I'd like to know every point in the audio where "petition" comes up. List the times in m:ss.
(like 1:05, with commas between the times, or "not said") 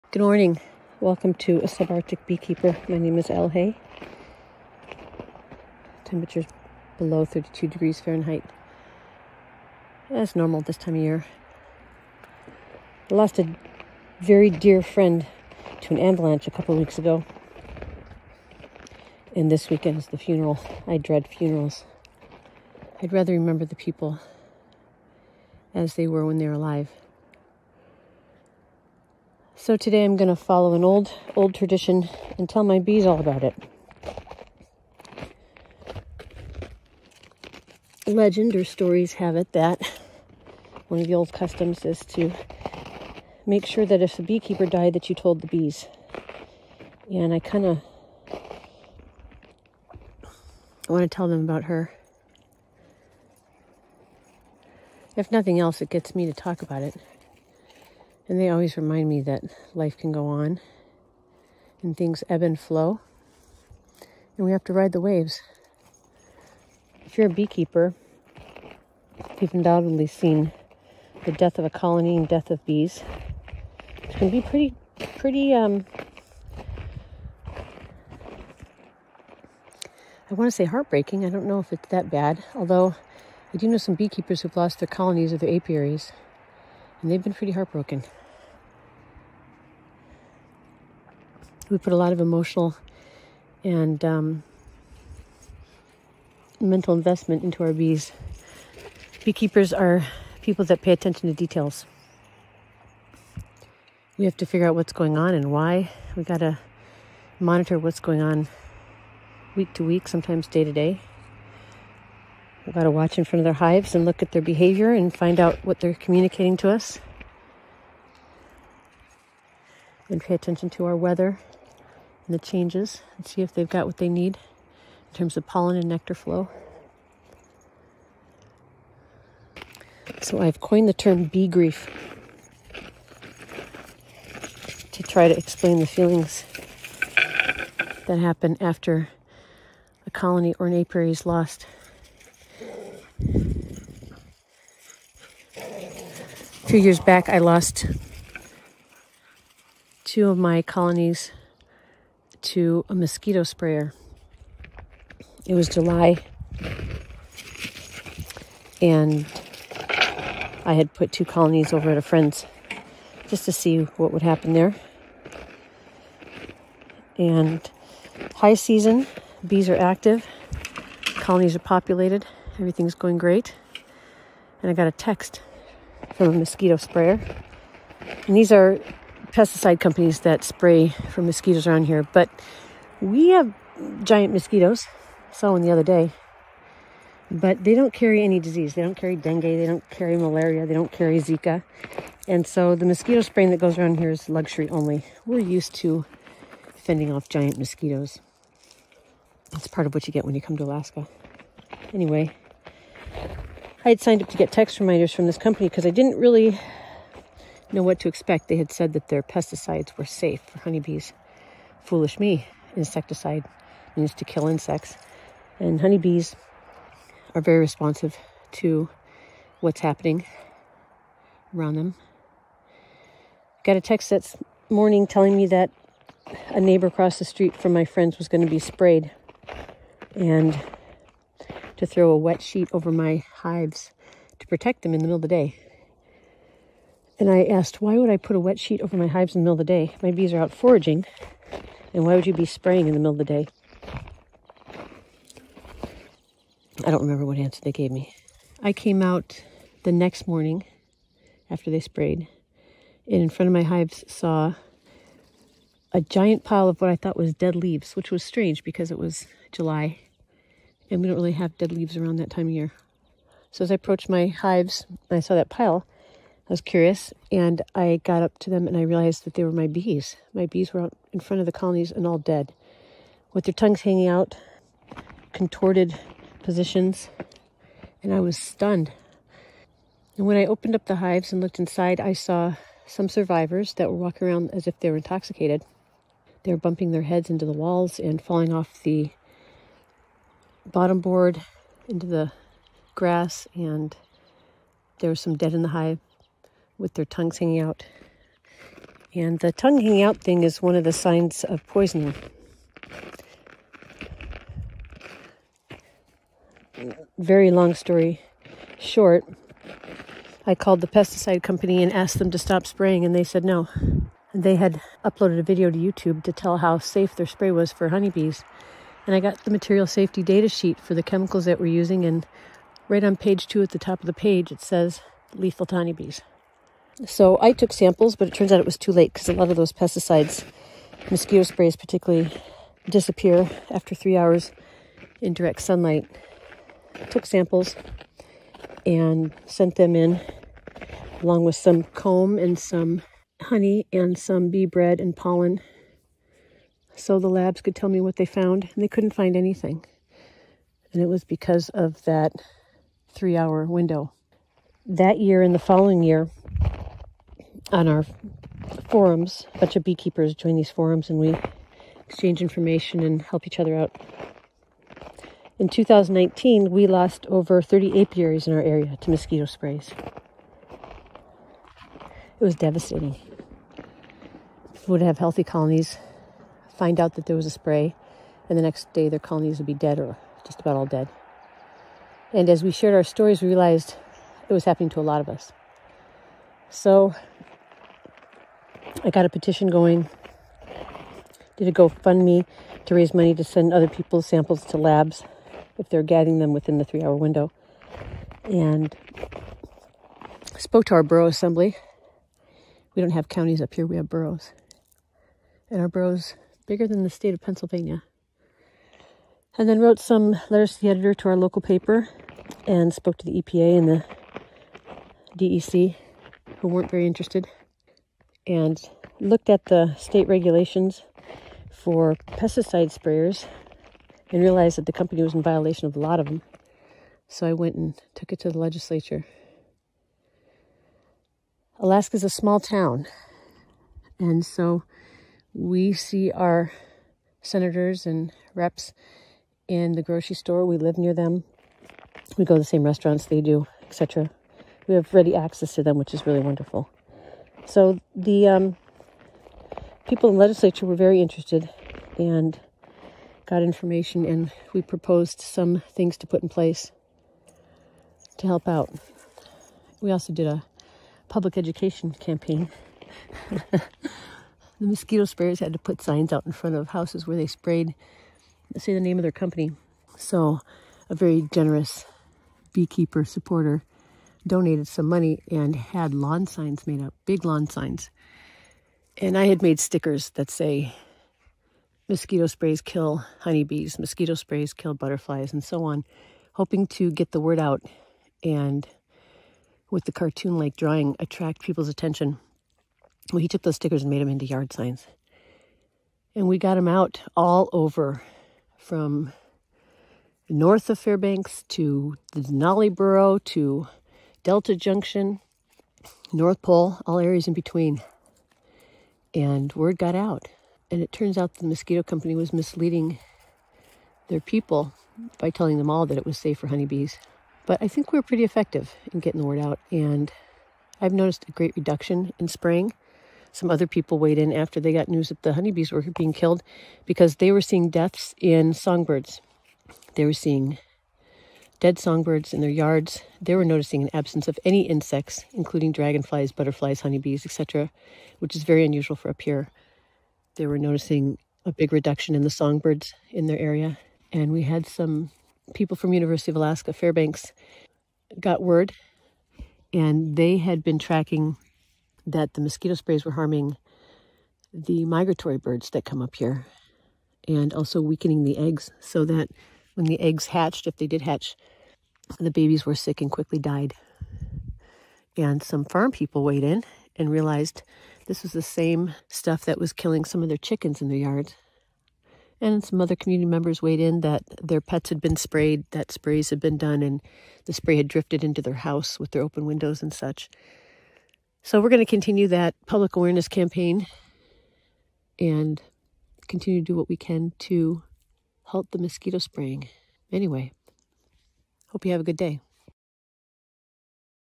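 6:29.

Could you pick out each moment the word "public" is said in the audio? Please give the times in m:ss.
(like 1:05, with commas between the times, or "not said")
7:41, 9:42.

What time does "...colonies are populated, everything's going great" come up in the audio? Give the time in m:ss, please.
2:51.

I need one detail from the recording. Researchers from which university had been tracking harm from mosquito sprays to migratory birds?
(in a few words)
University of Alaska Fairbanks.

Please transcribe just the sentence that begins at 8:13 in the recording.
Well, he took those stickers and made them into yard signs.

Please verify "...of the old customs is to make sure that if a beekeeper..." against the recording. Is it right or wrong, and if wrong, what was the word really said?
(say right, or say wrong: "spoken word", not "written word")
right.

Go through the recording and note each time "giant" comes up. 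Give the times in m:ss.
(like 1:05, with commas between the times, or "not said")
3:04, 3:17, 4:16.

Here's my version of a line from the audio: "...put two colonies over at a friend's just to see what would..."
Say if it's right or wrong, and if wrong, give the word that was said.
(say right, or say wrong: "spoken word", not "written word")
right.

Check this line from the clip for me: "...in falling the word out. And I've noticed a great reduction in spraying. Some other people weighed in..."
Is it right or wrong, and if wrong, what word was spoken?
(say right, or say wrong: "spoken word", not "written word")
wrong: "getting", not "falling".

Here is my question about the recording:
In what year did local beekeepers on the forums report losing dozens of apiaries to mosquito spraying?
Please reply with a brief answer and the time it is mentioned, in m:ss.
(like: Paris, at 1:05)
2019, at 6:05.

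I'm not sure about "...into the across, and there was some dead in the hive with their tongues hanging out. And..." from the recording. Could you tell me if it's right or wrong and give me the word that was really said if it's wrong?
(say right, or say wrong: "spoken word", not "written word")
wrong: "grass", not "across".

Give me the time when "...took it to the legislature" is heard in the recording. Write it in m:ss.
7:08.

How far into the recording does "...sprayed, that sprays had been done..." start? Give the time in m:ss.
9:35.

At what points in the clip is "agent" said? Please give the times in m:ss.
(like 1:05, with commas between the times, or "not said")
not said.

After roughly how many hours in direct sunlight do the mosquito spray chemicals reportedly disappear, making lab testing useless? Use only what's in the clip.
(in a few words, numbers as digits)
3 hours.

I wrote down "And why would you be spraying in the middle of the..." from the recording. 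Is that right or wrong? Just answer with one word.
right.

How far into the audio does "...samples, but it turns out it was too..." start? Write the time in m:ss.
5:27.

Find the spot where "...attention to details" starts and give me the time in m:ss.
1:40.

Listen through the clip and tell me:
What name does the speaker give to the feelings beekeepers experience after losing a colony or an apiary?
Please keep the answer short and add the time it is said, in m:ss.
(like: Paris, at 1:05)
bee grief, at 2:11.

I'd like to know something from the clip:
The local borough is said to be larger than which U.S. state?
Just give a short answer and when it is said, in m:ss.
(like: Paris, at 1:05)
Pennsylvania, at 6:47.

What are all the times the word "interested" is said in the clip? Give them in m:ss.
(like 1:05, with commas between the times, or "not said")
6:57, 7:31.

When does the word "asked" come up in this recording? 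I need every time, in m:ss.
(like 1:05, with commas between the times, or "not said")
3:57, 5:11.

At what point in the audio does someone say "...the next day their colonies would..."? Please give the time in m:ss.
6:18.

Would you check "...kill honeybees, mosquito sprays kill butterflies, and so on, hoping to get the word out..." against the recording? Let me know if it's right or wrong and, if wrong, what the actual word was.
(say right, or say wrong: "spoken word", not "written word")
right.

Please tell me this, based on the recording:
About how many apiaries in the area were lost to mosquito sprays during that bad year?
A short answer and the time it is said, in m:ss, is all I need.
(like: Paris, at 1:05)
over 30, at 6:07.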